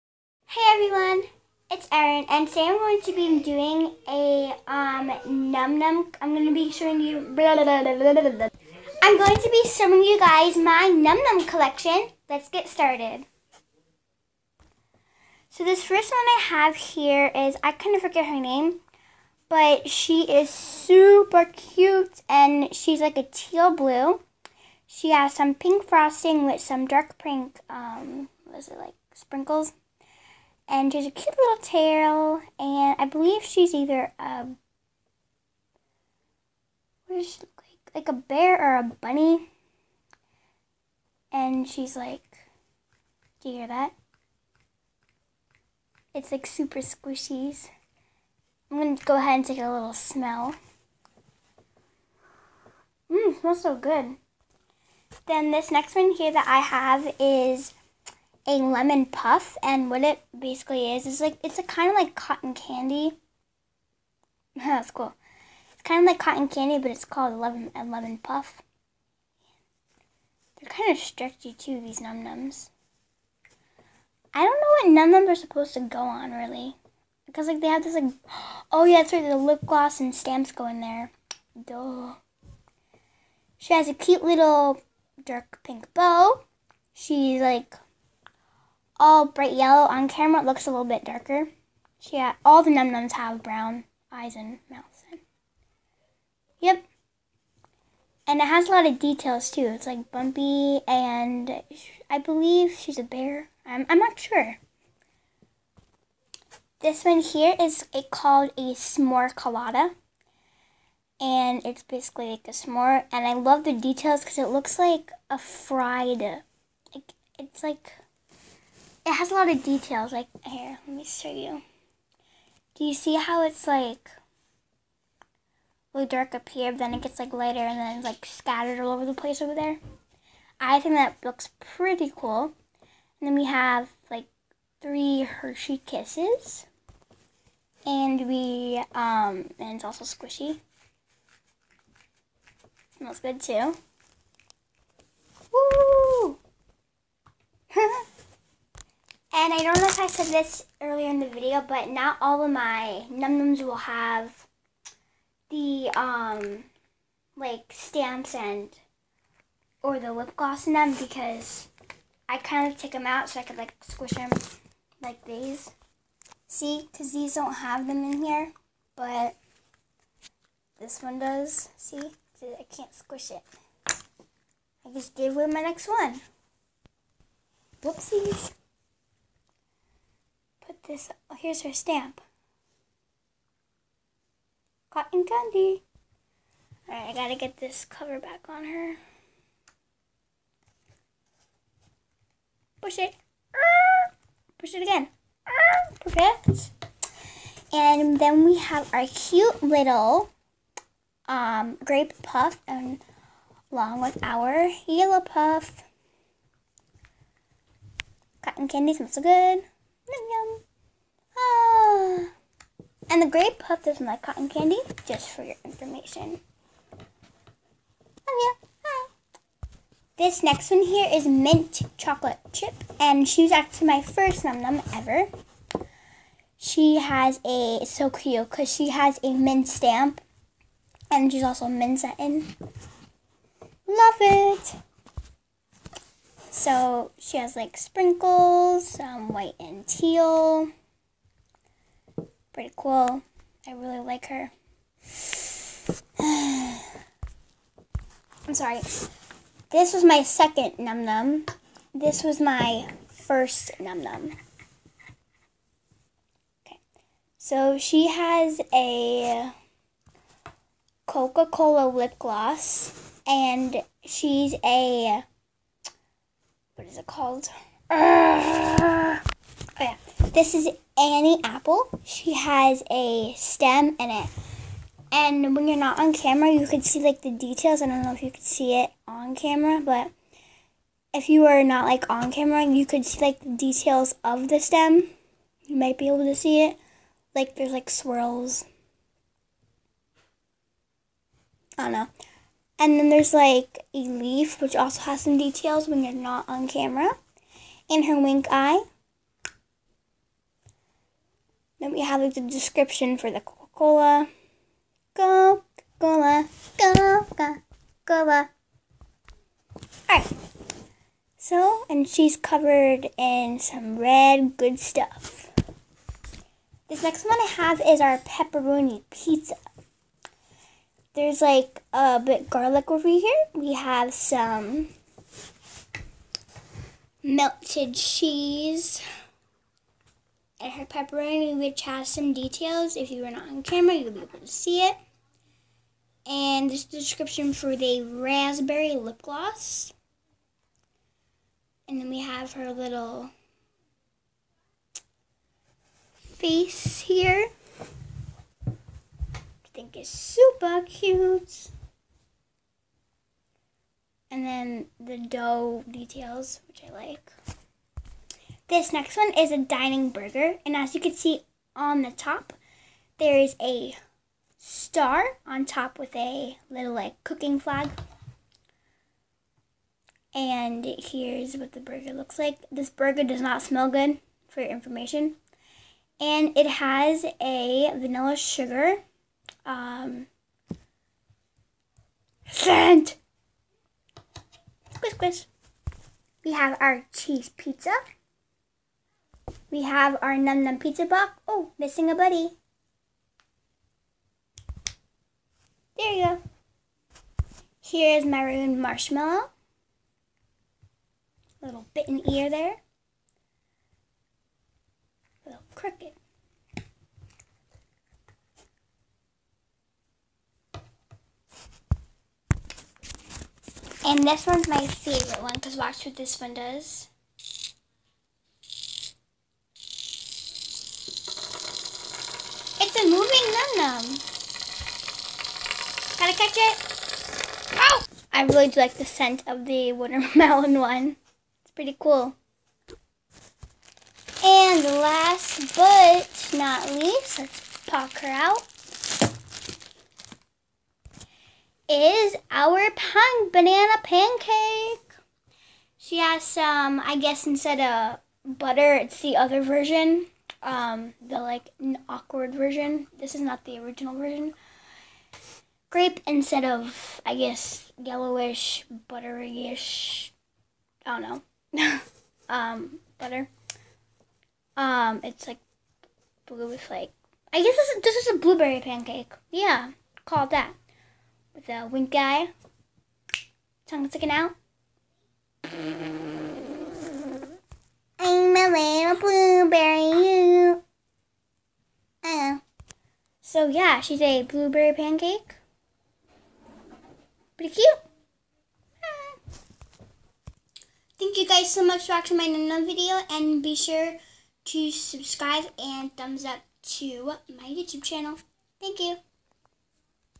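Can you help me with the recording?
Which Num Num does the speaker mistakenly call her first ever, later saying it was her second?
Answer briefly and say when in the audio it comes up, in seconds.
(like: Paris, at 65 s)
Mint chocolate chip, at 221 s.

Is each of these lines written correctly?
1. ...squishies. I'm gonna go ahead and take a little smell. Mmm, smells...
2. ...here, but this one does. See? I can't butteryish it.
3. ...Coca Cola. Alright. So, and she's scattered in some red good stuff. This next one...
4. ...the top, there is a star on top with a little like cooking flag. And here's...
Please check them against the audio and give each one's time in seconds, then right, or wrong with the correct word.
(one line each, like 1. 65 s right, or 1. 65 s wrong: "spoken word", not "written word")
1. 46 s right
2. 168 s wrong: "squish", not "butteryish"
3. 306 s wrong: "covered", not "scattered"
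4. 362 s right.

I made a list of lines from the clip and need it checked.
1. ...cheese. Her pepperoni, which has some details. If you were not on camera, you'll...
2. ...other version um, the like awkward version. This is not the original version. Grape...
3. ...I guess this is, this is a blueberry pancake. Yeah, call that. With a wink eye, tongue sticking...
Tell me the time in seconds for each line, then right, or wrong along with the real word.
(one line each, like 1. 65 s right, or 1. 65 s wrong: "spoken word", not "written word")
1. 327 s right
2. 449 s right
3. 467 s right.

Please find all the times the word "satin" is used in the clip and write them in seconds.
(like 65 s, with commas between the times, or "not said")
231 s.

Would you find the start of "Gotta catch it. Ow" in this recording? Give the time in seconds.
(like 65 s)
426 s.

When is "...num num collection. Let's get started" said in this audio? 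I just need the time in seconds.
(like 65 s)
10 s.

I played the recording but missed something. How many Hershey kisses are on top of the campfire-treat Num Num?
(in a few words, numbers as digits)
3.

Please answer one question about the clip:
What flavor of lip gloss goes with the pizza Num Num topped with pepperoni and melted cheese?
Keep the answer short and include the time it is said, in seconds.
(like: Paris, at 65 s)
Raspberry, at 338 s.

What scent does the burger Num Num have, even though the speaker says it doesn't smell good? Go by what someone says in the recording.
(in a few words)
Vanilla sugar.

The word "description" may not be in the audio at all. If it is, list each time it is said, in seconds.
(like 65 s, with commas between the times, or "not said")
302 s, 336 s.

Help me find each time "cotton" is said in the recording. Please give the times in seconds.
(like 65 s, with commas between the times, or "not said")
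62 s, 66 s, 184 s, 208 s, 214 s.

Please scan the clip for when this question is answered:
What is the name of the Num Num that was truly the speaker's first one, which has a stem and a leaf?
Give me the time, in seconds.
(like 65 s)
270 s.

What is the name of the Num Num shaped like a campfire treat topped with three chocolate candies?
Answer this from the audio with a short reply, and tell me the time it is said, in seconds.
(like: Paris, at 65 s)
S'more colada, at 108 s.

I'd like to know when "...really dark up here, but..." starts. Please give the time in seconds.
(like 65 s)
125 s.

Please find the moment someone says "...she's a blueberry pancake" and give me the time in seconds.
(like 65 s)
484 s.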